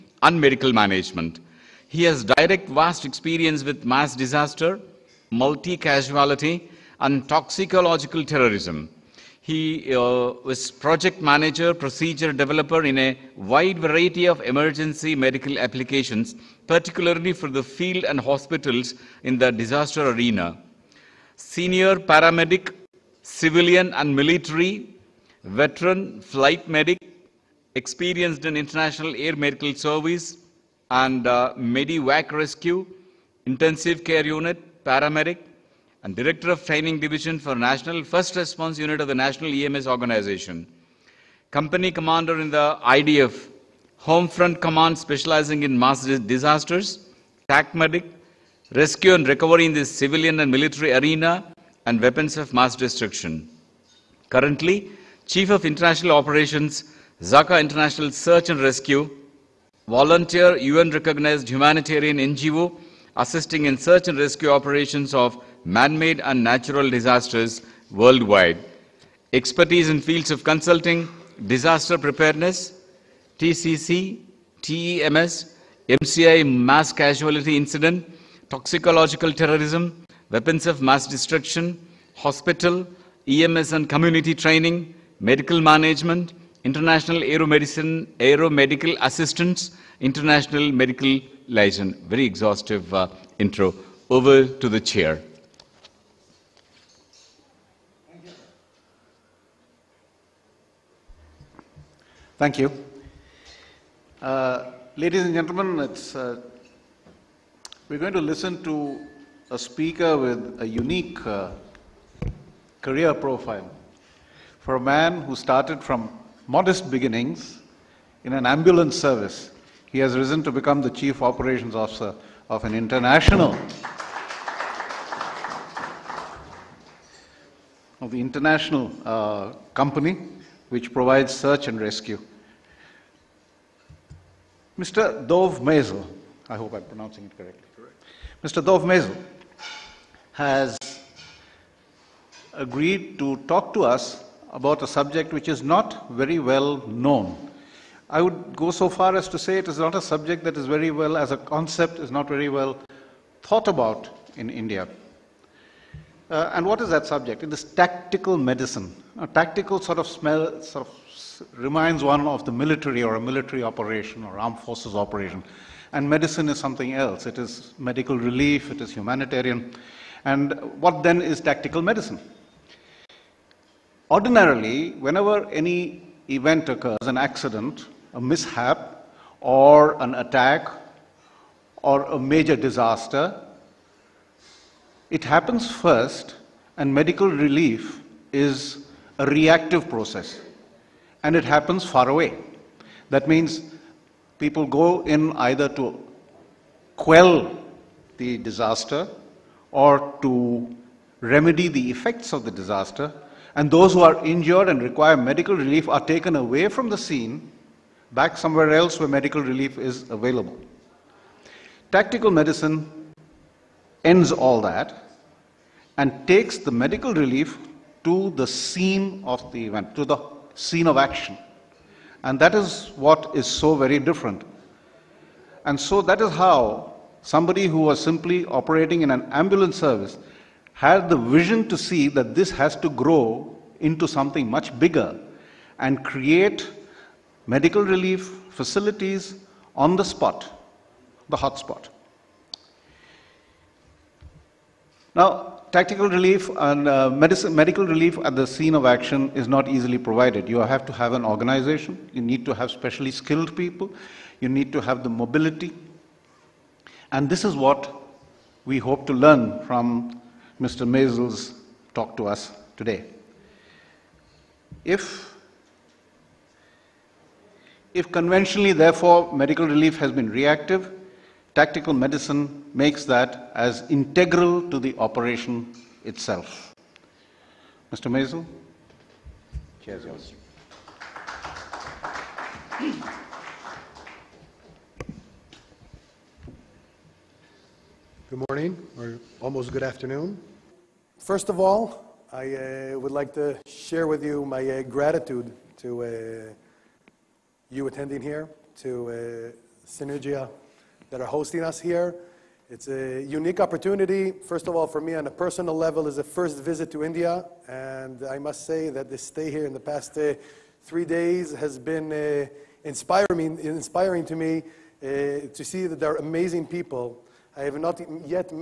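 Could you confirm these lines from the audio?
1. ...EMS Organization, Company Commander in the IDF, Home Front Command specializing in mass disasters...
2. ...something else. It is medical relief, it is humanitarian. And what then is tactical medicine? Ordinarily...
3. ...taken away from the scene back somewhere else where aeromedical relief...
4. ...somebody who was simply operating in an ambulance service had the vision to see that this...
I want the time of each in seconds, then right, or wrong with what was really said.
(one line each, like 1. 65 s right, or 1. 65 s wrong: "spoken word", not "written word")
1. 39 s right
2. 166 s right
3. 206 s wrong: "medical", not "aeromedical"
4. 227 s right.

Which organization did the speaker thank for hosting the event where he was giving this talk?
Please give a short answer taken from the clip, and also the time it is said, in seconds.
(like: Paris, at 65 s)
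Synergia, at 299 s.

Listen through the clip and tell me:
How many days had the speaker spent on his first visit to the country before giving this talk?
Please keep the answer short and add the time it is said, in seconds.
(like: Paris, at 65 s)
3, at 310 s.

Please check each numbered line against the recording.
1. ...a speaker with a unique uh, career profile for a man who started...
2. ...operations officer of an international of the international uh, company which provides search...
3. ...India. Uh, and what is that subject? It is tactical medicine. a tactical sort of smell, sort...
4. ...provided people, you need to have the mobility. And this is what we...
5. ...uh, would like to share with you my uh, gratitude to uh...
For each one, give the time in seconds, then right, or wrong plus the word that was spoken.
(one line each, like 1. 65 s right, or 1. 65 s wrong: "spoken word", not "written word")
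1. 109 s right
2. 121 s right
3. 154 s right
4. 253 s wrong: "skilled", not "provided"
5. 292 s right.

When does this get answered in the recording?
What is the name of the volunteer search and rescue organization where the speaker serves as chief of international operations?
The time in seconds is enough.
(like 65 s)
57 s.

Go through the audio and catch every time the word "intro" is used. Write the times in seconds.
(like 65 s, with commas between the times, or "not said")
93 s.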